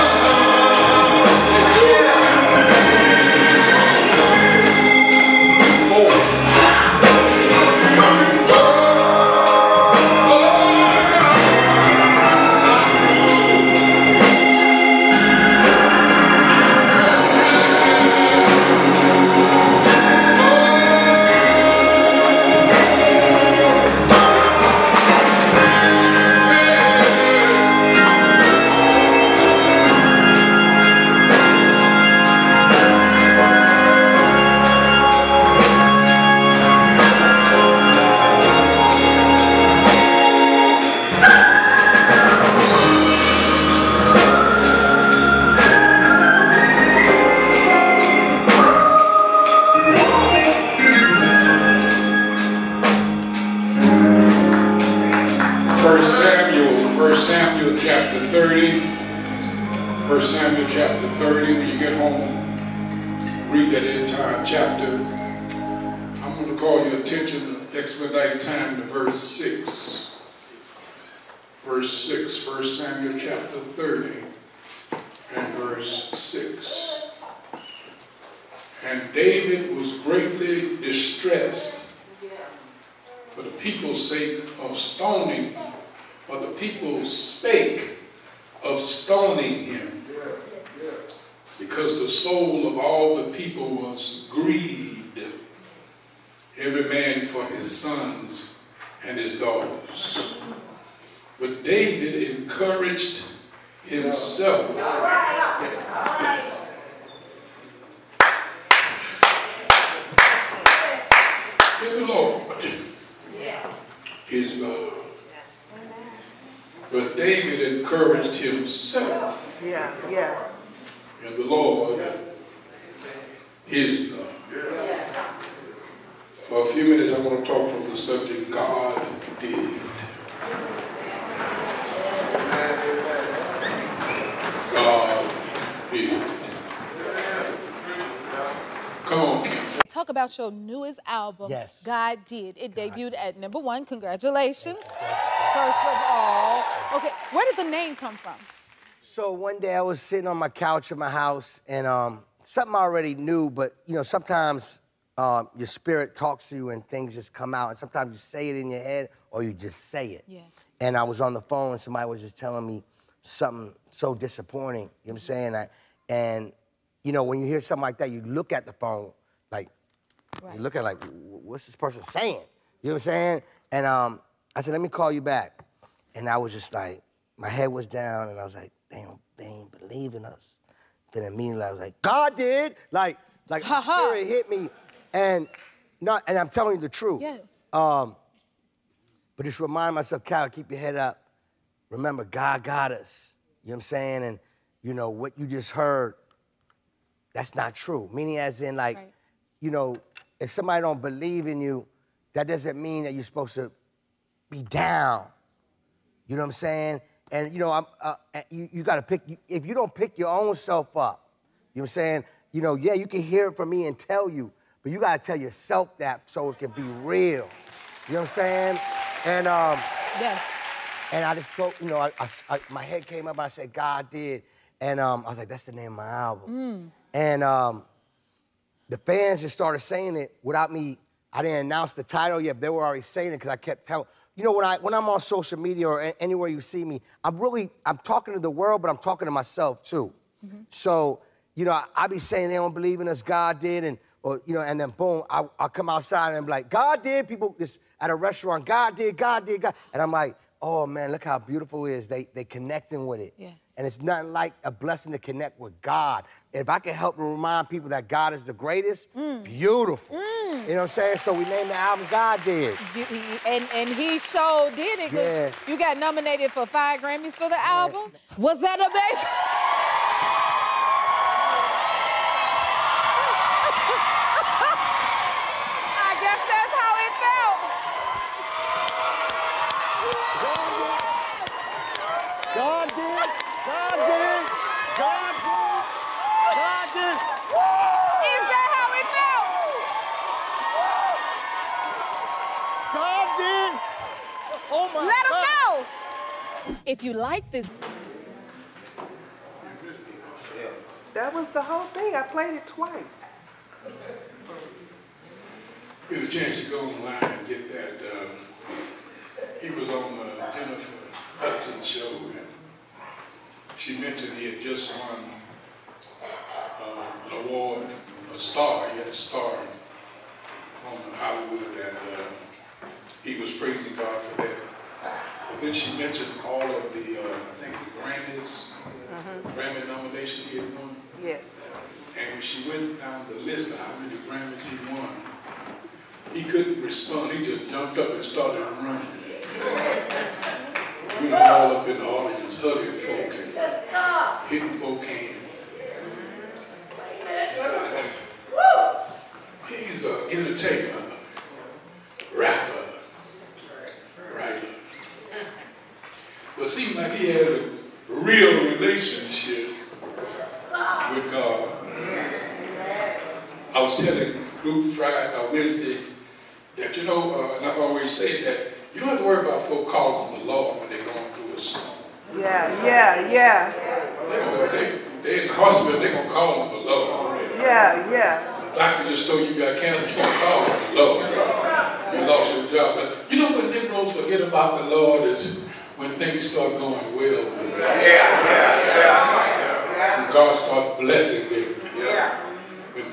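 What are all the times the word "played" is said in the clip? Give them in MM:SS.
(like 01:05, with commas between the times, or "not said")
05:02.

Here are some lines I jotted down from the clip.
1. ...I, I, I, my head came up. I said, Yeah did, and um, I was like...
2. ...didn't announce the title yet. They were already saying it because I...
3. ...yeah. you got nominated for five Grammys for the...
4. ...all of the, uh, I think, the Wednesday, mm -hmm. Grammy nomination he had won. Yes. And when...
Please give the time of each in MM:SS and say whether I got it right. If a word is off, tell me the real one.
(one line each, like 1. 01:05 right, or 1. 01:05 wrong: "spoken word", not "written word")
1. 03:41 wrong: "God", not "Yeah"
2. 03:51 right
3. 04:25 right
4. 05:26 wrong: "Grammys", not "Wednesday".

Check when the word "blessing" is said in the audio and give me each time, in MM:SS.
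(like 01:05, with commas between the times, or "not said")
04:14, 06:31.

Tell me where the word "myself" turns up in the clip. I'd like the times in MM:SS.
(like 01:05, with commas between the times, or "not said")
03:09, 03:59.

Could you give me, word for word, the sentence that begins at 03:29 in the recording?
If you don't pick your own self up, you know what I'm saying?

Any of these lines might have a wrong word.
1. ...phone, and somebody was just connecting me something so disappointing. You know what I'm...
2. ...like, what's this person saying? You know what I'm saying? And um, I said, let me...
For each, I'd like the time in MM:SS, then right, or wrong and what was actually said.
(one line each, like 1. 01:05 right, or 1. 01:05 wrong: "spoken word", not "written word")
1. 02:41 wrong: "telling", not "connecting"
2. 02:50 right.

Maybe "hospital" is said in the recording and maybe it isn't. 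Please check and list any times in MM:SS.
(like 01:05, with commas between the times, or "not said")
06:15.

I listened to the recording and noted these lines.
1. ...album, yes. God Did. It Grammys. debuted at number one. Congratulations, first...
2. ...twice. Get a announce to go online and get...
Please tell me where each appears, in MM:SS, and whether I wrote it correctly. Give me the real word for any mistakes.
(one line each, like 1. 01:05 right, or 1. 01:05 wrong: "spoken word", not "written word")
1. 02:21 wrong: "God", not "Grammys"
2. 05:02 wrong: "chance", not "announce".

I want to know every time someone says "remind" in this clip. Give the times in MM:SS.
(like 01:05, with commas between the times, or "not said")
03:09, 04:17.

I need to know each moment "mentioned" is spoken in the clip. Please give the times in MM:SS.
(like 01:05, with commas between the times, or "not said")
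05:13, 05:25.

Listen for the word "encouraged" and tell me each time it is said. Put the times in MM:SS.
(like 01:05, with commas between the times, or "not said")
01:42, 01:57.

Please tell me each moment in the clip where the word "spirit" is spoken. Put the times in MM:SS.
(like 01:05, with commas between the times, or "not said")
02:35, 03:03.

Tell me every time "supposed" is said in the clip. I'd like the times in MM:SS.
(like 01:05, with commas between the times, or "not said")
03:23.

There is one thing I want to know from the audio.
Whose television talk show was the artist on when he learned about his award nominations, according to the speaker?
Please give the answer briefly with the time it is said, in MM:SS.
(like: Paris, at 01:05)
Jennifer Hudson, at 05:10.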